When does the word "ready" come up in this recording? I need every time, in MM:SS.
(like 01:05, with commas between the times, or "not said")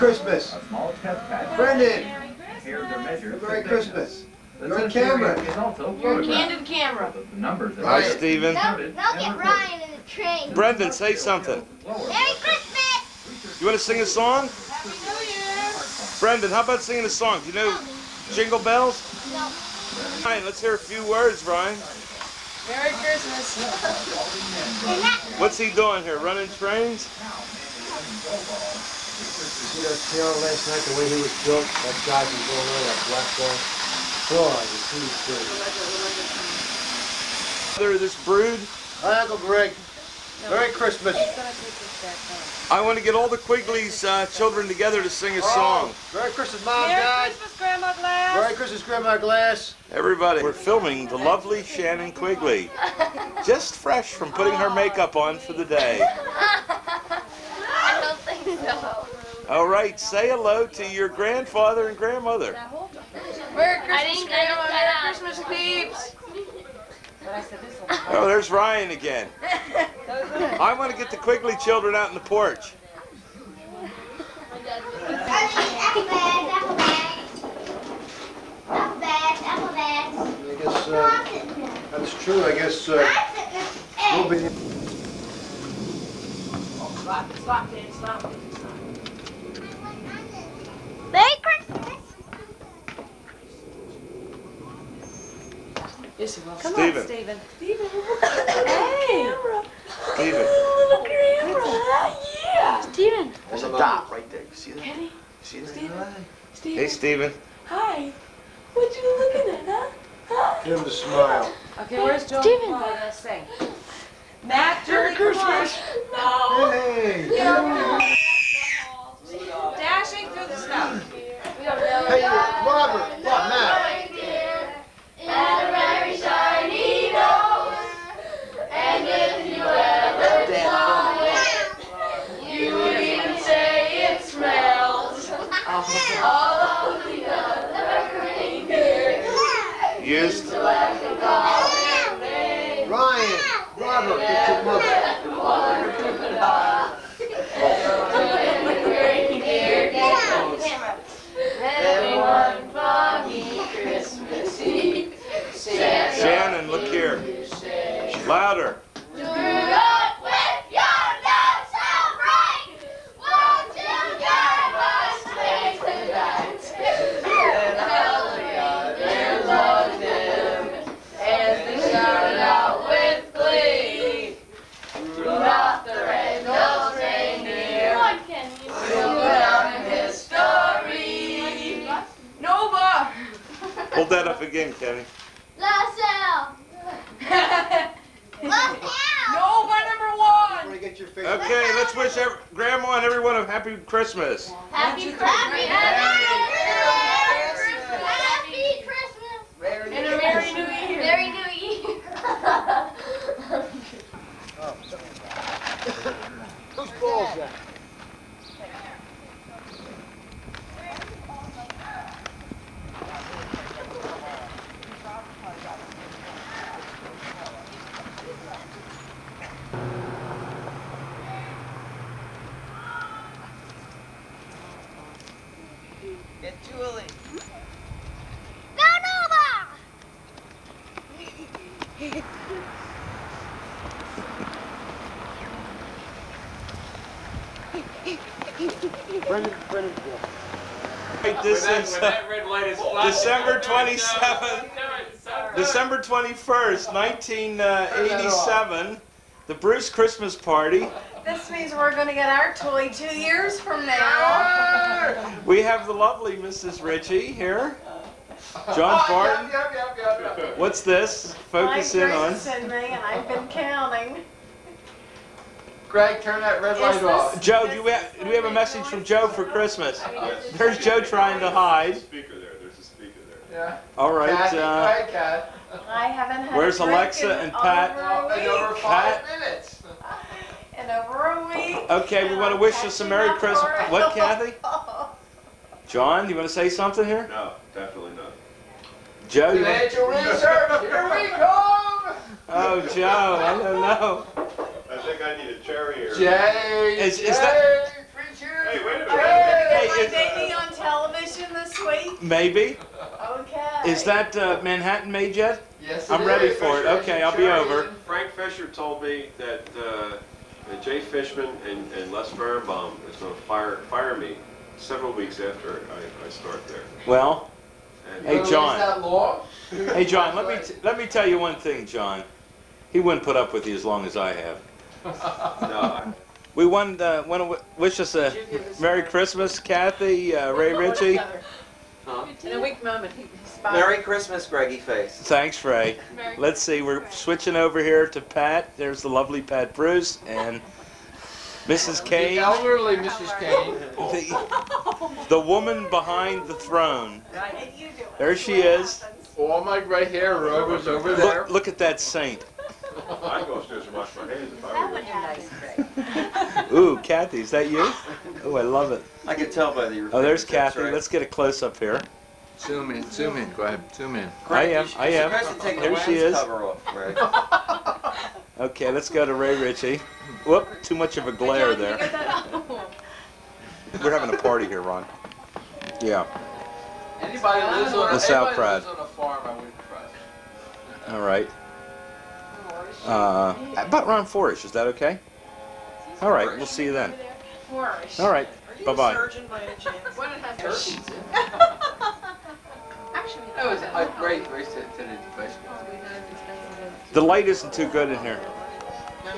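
05:06.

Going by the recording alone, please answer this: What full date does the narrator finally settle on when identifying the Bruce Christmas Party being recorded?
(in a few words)
December 21st, 1987.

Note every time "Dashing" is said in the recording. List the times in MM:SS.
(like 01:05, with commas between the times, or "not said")
01:59.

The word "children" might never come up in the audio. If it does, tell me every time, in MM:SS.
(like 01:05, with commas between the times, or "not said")
00:44, 01:11.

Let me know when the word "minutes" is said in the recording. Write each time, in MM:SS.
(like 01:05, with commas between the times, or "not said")
04:39, 04:58.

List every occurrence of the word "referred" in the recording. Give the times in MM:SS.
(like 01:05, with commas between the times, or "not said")
not said.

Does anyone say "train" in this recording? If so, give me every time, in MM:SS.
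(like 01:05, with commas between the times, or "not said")
00:10, 00:26.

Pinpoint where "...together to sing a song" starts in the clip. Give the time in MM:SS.
00:44.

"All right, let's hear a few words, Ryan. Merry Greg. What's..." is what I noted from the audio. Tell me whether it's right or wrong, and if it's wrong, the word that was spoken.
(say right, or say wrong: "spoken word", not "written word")
wrong: "Christmas", not "Greg".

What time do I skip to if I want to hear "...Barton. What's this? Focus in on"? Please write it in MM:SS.
04:20.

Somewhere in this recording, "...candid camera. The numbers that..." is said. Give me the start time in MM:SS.
00:06.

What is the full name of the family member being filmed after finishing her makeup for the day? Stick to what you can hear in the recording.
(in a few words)
Shannon Quigley.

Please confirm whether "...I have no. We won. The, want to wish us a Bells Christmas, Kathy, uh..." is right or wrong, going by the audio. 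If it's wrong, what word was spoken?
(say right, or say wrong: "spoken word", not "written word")
wrong: "Merry", not "Bells".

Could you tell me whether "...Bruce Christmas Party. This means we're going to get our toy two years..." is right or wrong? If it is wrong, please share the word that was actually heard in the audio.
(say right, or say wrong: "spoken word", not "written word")
right.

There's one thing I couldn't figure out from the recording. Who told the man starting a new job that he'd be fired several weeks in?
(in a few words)
Frank Fisher.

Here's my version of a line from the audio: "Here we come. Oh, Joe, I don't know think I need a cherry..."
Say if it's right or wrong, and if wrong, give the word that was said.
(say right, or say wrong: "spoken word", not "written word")
right.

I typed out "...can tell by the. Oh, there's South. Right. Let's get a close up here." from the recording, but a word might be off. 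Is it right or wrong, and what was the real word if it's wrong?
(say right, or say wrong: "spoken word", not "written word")
wrong: "Kathy", not "South".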